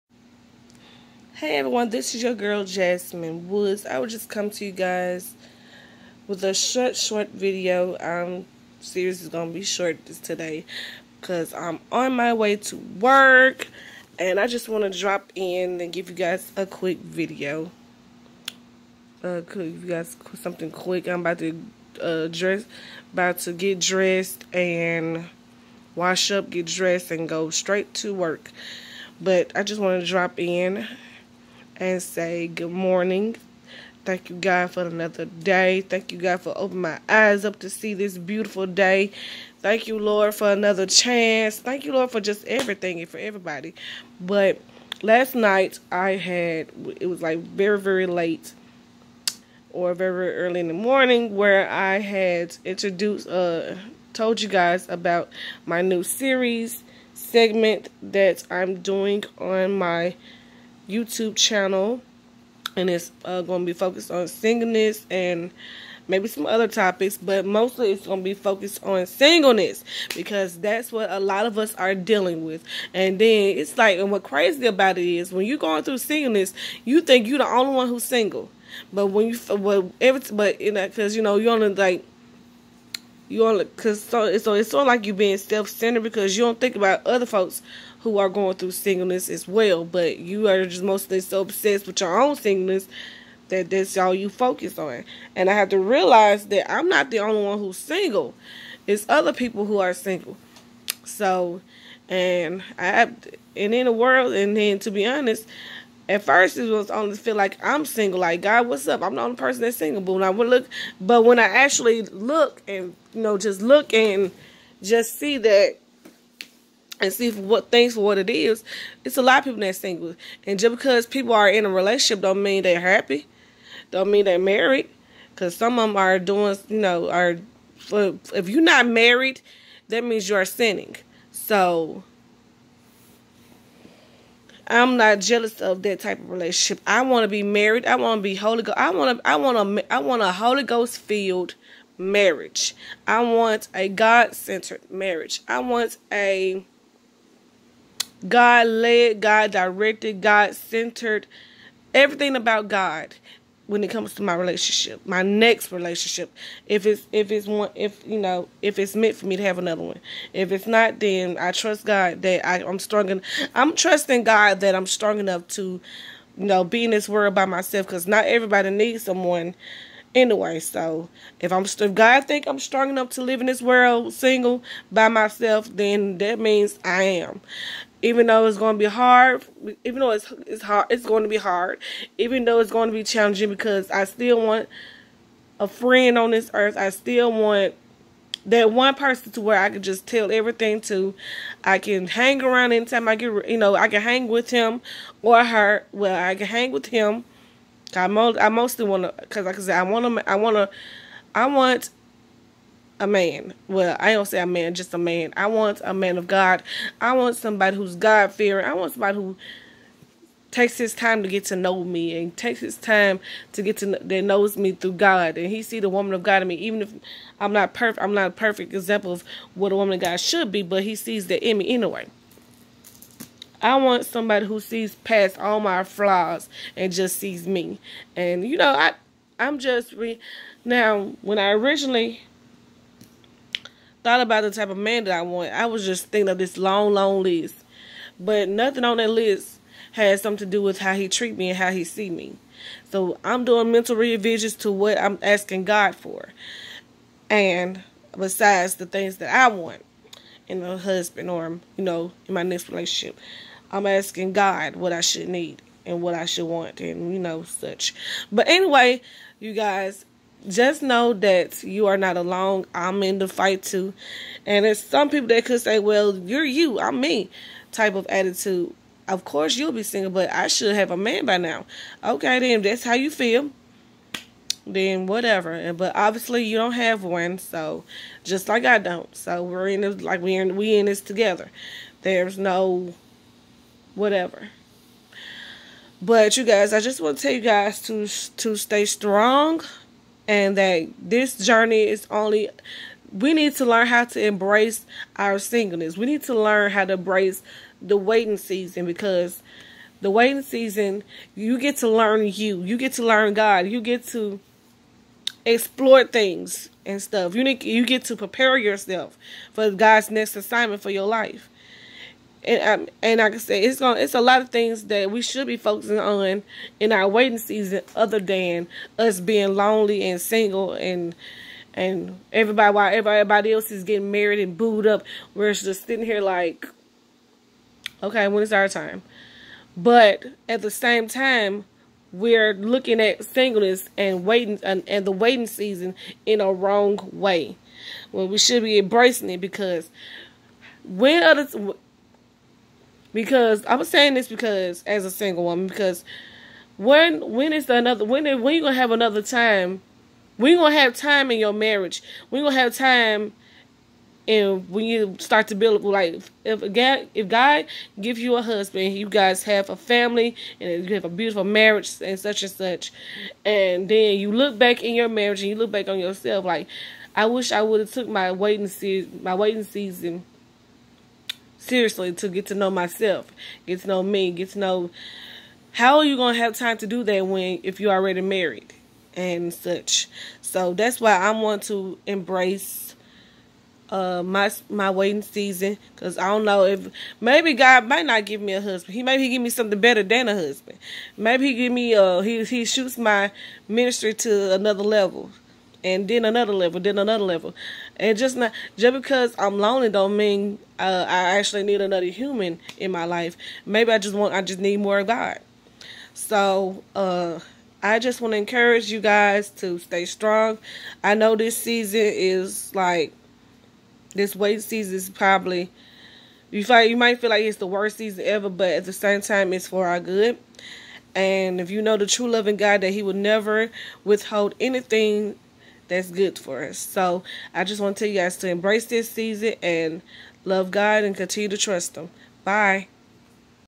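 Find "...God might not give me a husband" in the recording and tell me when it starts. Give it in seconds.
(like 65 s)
387 s.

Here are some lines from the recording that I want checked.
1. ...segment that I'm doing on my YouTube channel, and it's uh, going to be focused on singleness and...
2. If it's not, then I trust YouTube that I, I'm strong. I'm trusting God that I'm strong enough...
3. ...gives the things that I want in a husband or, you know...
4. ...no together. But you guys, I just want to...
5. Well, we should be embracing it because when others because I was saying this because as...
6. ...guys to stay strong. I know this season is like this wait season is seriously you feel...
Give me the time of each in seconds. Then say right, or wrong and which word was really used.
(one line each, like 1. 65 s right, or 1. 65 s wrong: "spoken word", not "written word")
1. 57 s right
2. 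160 s wrong: "God", not "YouTube"
3. 248 s wrong: "besides", not "gives"
4. 282 s wrong: "whatever", not "together"
5. 338 s right
6. 408 s wrong: "probably", not "seriously".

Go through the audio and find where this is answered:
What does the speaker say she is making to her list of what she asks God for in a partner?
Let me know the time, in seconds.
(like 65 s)
243 s.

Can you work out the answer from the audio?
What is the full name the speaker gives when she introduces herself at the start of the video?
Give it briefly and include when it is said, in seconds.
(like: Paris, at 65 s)
Jasmine Woods, at 2 s.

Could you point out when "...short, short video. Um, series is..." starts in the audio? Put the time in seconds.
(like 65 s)
6 s.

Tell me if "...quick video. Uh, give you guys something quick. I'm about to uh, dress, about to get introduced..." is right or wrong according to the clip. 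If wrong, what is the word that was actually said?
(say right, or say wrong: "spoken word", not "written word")
wrong: "dressed", not "introduced".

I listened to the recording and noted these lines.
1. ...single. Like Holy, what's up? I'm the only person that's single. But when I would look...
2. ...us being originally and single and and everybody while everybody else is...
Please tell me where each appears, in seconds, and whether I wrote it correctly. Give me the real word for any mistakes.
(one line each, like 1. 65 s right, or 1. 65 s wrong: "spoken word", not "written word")
1. 107 s wrong: "God", not "Holy"
2. 318 s wrong: "lonely", not "originally".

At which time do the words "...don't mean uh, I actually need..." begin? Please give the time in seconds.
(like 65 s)
399 s.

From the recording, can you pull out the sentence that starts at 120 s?
And just because people are in a relationship, don't mean they're happy.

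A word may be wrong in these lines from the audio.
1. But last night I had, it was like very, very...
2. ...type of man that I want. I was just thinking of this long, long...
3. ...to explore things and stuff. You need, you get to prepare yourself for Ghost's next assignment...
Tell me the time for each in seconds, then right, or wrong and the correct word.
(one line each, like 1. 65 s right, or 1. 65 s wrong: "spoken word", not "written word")
1. 44 s right
2. 234 s right
3. 304 s wrong: "God", not "Ghost".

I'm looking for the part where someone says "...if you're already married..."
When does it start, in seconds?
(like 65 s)
377 s.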